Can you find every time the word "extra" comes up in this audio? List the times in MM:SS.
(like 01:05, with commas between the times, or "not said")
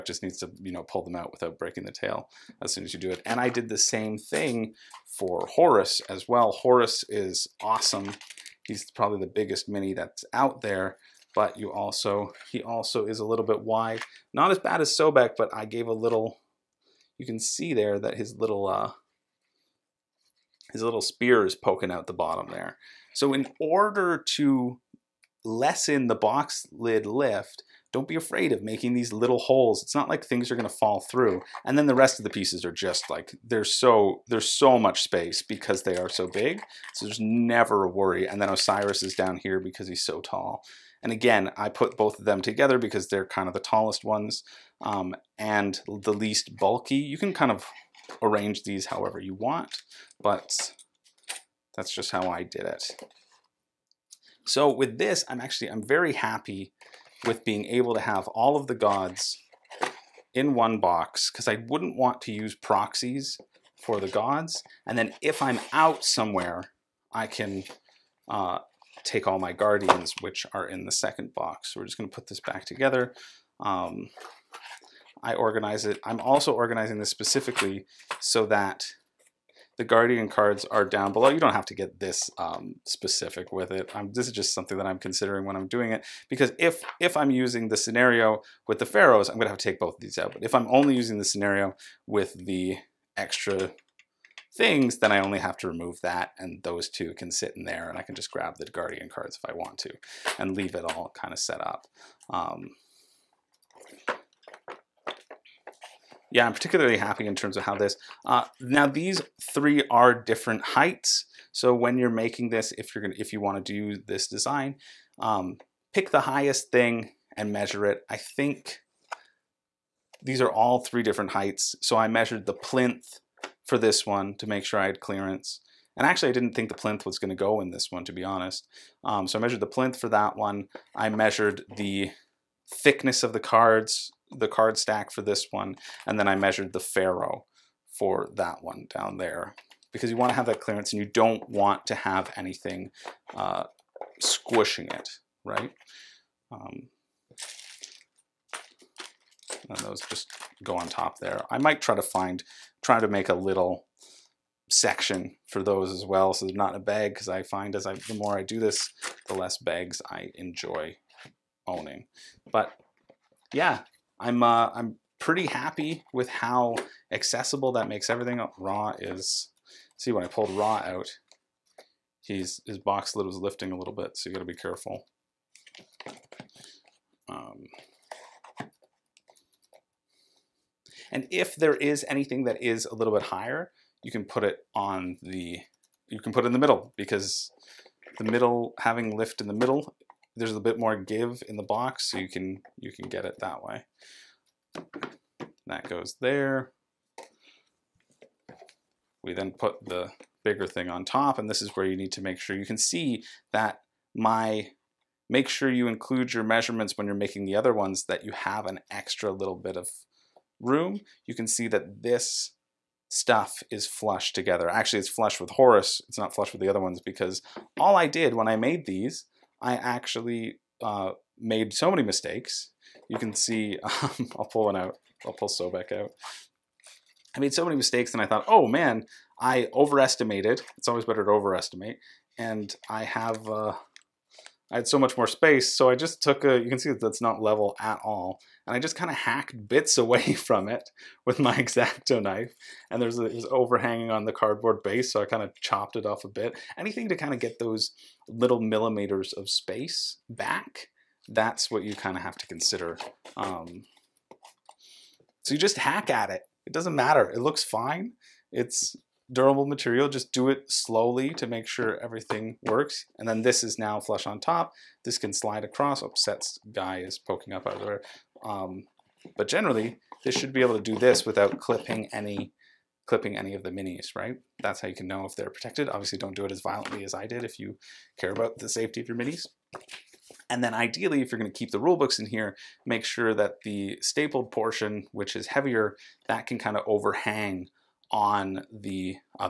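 01:33, 03:28.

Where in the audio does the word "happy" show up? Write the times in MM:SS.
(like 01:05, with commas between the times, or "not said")
00:56, 01:46, 02:45.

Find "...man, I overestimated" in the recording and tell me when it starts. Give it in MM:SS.
03:48.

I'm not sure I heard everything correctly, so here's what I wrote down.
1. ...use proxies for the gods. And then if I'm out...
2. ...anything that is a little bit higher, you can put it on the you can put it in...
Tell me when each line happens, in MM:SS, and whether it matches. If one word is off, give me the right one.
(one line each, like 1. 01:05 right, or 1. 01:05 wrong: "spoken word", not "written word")
1. 01:02 right
2. 03:02 right.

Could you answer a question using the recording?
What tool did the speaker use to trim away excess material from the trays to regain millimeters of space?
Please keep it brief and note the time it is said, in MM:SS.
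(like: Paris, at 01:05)
X-Acto knife, at 04:01.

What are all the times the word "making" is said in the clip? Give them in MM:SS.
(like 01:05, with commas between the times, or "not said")
00:28, 01:52, 03:27.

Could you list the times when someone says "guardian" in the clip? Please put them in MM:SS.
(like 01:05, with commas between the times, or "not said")
01:09, 01:19, 01:38.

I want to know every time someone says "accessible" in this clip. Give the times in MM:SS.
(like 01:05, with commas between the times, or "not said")
02:47.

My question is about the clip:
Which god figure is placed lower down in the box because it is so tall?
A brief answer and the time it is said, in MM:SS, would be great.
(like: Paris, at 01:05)
Osiris, at 00:38.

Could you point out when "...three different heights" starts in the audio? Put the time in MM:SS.
02:00.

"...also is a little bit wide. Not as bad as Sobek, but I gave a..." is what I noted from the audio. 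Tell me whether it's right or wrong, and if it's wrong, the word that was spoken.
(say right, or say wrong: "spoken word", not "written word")
right.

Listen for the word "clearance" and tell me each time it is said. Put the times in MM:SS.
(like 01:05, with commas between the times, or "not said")
02:04, 02:20.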